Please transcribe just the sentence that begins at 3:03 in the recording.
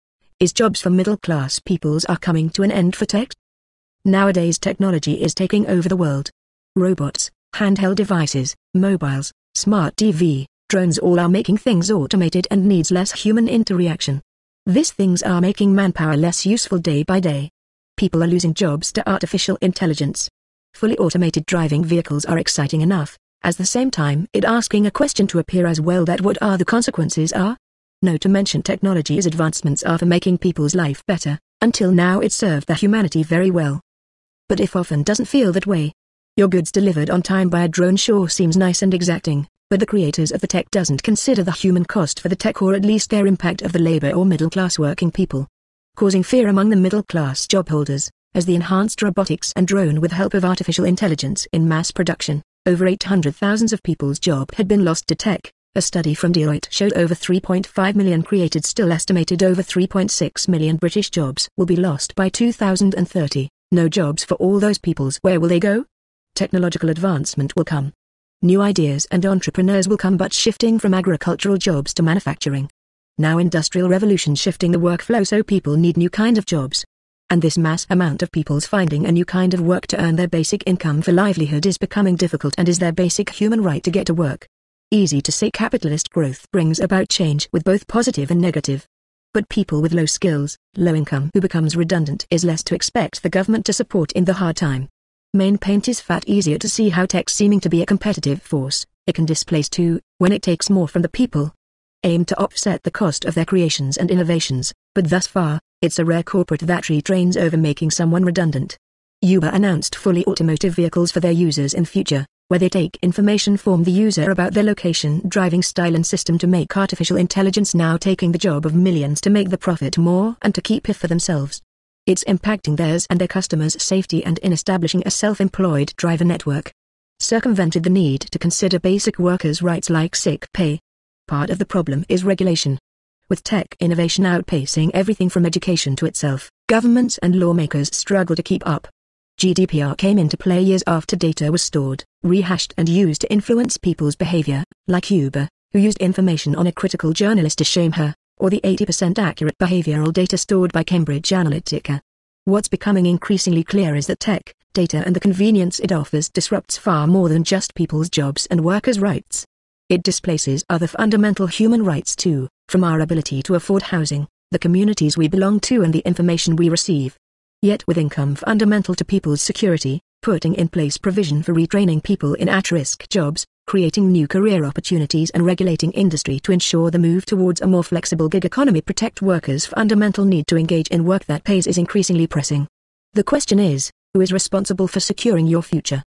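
The question is, who is responsible for securing your future?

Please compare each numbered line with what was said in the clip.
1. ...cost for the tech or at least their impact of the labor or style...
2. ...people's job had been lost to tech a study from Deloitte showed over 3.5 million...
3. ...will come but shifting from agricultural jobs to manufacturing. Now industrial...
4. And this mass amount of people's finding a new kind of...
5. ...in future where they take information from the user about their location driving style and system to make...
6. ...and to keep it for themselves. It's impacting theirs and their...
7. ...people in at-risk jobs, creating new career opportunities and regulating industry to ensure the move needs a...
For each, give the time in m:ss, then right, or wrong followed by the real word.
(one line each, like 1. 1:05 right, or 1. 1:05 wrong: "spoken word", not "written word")
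1. 0:41 wrong: "middle", not "style"
2. 0:53 right
3. 1:09 right
4. 1:17 right
5. 1:51 right
6. 2:00 right
7. 2:52 wrong: "towards", not "needs".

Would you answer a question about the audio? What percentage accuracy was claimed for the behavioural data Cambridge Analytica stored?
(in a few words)
80%.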